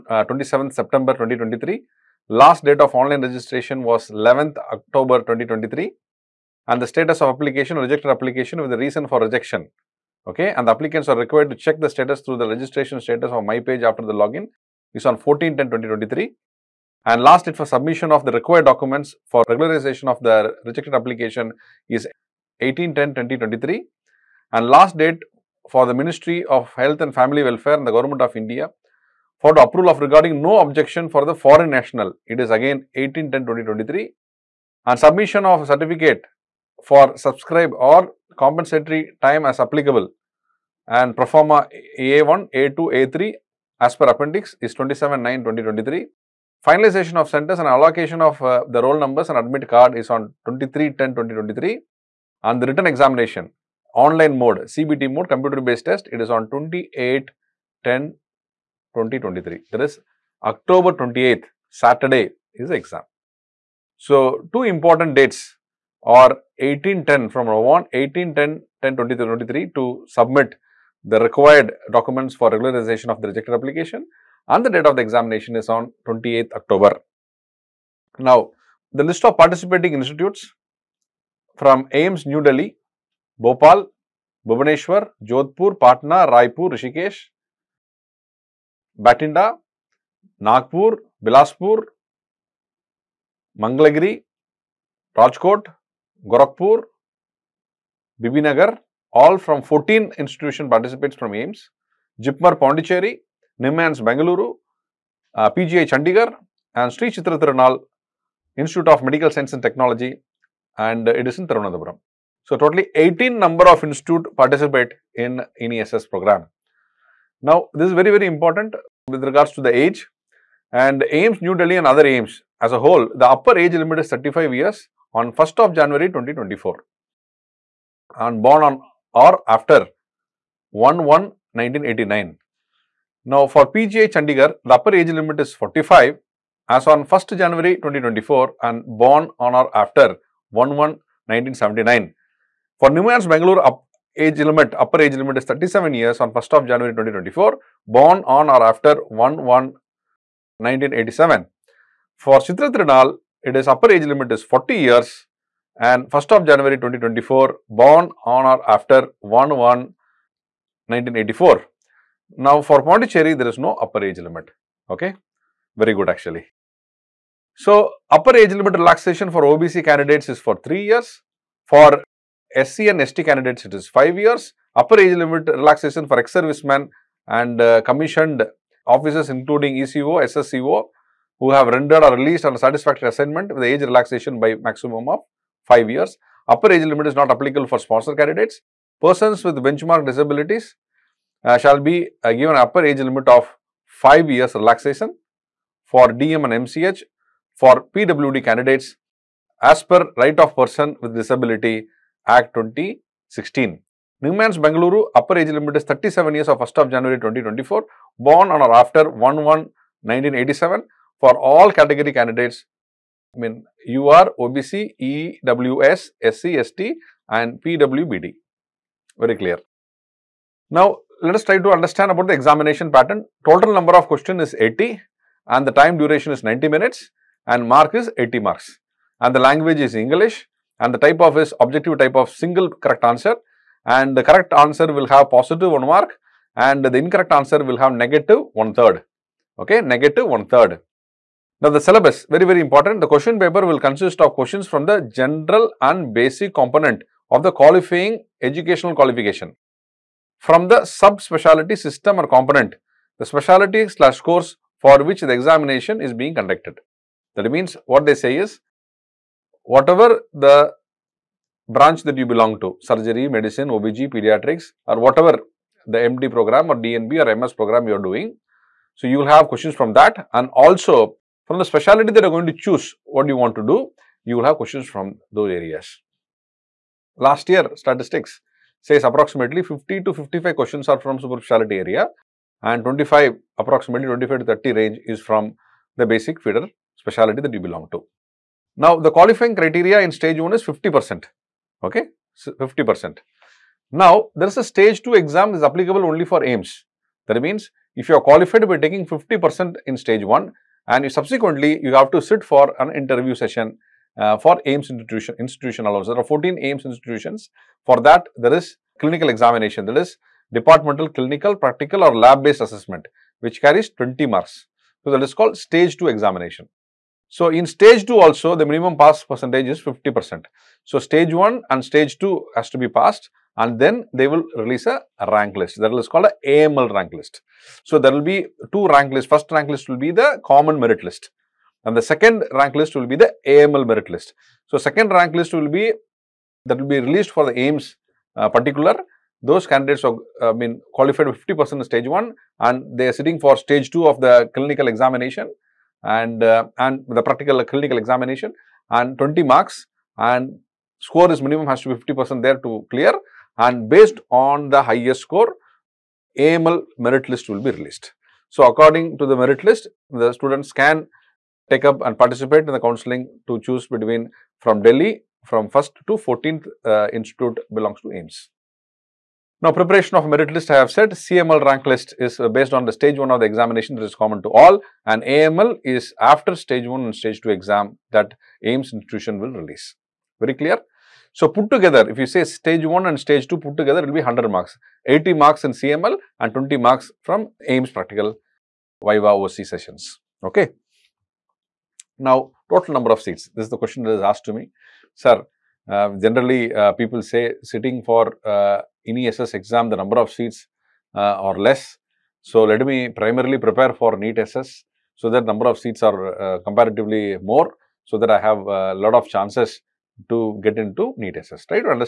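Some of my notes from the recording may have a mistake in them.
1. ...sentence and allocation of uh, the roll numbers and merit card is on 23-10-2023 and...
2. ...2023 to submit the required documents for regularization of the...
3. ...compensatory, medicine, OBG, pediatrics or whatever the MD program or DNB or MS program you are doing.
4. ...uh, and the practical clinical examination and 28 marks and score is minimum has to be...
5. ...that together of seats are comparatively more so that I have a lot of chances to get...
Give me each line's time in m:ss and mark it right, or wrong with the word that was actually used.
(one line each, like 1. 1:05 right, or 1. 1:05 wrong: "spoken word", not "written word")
1. 0:47 wrong: "admit", not "merit"
2. 1:08 right
3. 4:22 wrong: "surgery", not "compensatory"
4. 5:46 wrong: "20", not "28"
5. 6:45 wrong: "number", not "together".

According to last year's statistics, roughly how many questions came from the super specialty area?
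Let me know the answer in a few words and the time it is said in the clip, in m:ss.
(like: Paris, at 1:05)
50 to 55, at 4:39.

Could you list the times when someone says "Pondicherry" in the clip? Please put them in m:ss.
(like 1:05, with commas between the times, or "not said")
1:42, 2:42.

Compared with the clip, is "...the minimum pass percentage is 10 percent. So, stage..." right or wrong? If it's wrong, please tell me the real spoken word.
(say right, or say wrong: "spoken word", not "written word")
wrong: "50", not "10".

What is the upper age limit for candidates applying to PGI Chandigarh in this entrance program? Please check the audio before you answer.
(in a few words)
45.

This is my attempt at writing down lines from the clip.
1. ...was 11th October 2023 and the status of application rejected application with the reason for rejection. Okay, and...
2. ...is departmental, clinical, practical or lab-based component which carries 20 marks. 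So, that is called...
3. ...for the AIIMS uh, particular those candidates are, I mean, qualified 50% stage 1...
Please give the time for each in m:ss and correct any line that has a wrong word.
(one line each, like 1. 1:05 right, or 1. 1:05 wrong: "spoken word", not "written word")
1. 0:03 right
2. 5:09 wrong: "assessment", not "component"
3. 5:37 right.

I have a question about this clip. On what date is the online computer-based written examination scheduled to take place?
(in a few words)
28 October 2023.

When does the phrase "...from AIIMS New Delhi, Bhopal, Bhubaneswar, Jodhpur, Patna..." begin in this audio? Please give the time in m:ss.
1:21.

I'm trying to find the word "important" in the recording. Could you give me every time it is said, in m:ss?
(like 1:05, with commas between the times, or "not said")
1:04, 1:58, 4:02.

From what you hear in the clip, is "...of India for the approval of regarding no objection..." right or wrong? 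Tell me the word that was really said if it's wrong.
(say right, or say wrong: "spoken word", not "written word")
right.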